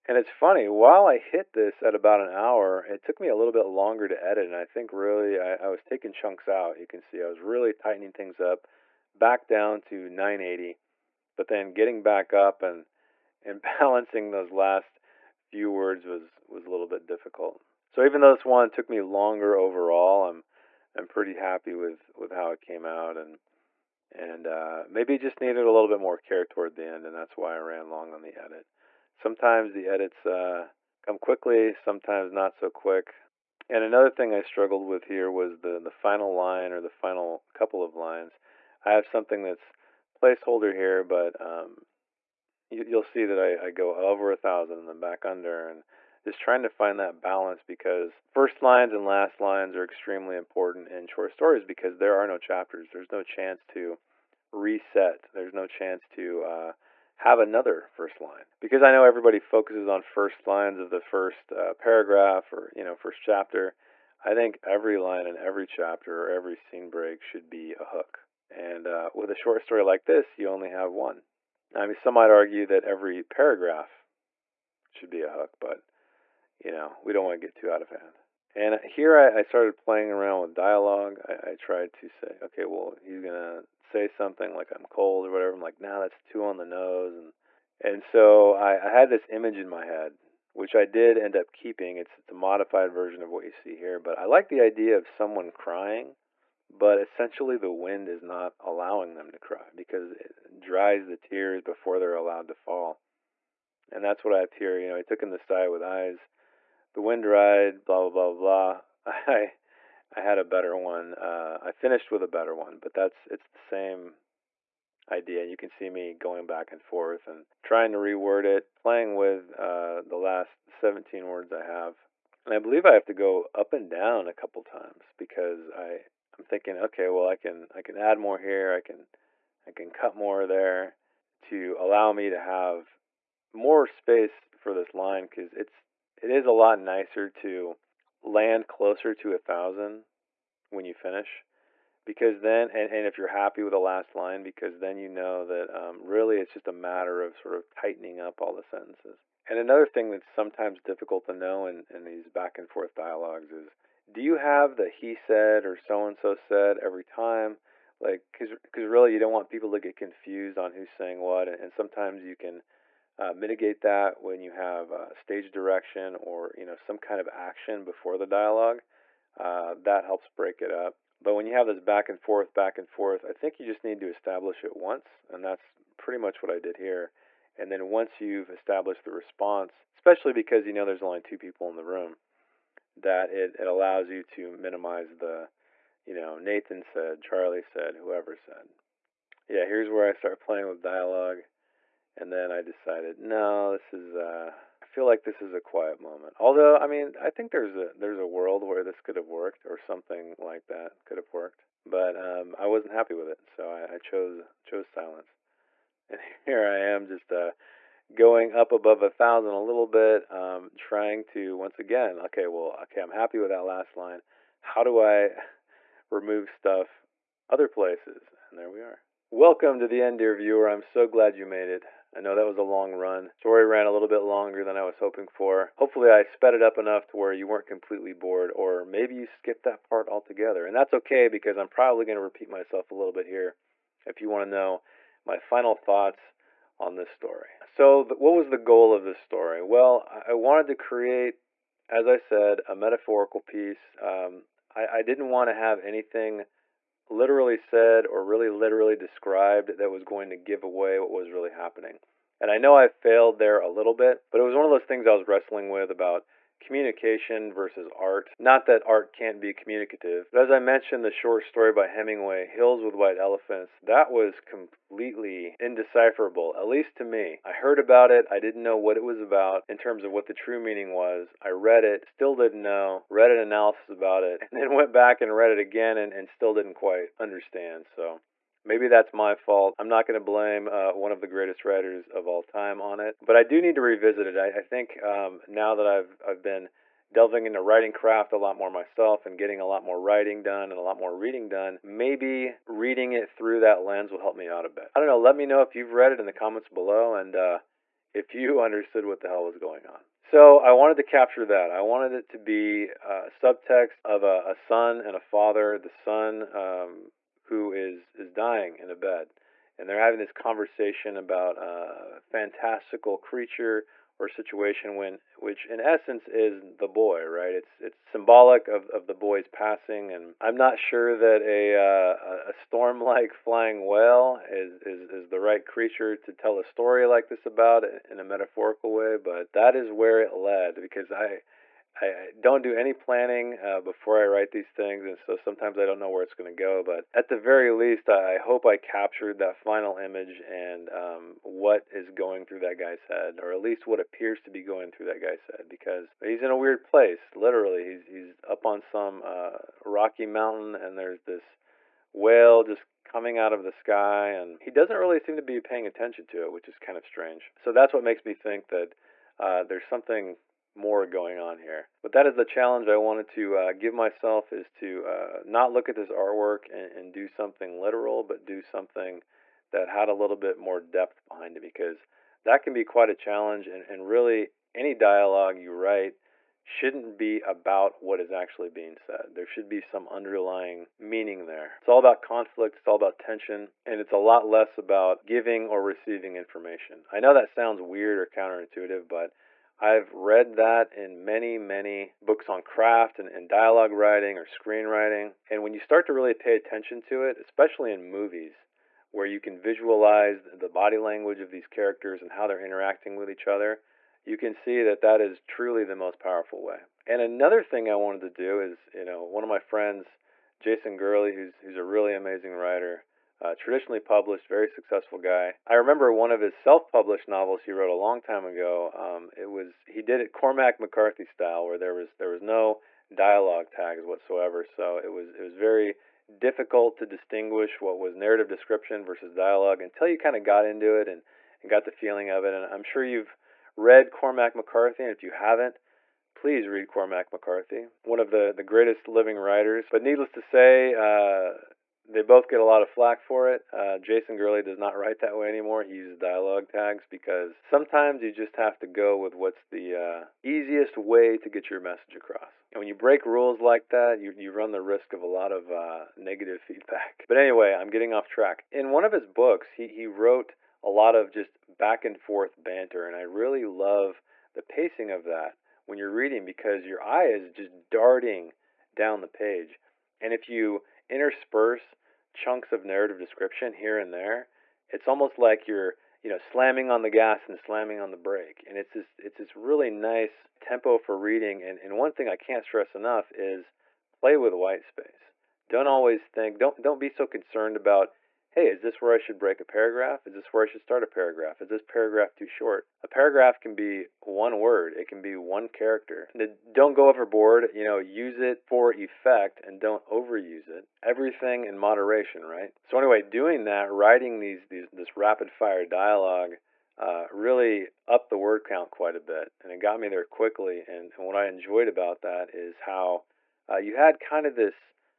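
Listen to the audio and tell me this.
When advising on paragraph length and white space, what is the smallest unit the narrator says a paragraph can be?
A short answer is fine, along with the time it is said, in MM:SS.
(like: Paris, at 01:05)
one character, at 08:15.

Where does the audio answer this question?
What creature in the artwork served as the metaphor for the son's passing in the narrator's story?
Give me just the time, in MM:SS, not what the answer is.
05:23.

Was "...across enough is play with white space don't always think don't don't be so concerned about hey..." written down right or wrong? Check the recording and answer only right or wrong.
wrong.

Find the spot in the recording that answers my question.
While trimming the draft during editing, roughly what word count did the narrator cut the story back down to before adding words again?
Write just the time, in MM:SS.
00:10.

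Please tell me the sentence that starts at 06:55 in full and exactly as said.
I remember one of his self-published novels he wrote a long time ago.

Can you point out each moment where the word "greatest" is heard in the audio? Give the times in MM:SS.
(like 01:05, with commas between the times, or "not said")
04:41, 07:18.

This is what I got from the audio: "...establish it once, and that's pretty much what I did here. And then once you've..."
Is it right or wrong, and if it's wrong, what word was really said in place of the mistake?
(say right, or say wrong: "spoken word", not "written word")
right.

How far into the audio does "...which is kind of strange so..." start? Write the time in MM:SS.
05:56.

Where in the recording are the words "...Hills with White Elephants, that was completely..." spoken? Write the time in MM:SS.
04:22.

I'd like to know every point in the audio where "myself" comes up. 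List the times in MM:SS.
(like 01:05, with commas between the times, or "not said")
03:52, 04:48, 06:03.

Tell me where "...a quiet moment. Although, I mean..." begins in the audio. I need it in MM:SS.
03:15.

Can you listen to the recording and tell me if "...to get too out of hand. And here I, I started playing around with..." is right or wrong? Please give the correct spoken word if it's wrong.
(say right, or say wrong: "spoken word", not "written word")
right.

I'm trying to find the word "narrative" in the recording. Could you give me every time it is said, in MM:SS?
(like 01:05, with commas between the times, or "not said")
07:08, 07:52.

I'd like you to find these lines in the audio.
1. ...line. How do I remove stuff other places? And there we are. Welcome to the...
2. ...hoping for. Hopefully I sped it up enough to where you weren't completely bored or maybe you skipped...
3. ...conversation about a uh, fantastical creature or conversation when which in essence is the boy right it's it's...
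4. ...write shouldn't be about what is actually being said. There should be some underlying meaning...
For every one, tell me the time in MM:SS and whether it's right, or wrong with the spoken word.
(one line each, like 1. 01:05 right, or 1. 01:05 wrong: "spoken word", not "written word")
1. 03:33 right
2. 03:44 right
3. 05:10 wrong: "situation", not "conversation"
4. 06:15 right.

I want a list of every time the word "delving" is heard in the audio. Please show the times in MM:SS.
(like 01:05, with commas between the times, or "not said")
04:47.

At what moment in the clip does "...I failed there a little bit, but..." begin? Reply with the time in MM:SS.
04:12.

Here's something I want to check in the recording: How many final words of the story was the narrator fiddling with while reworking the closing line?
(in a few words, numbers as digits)
17.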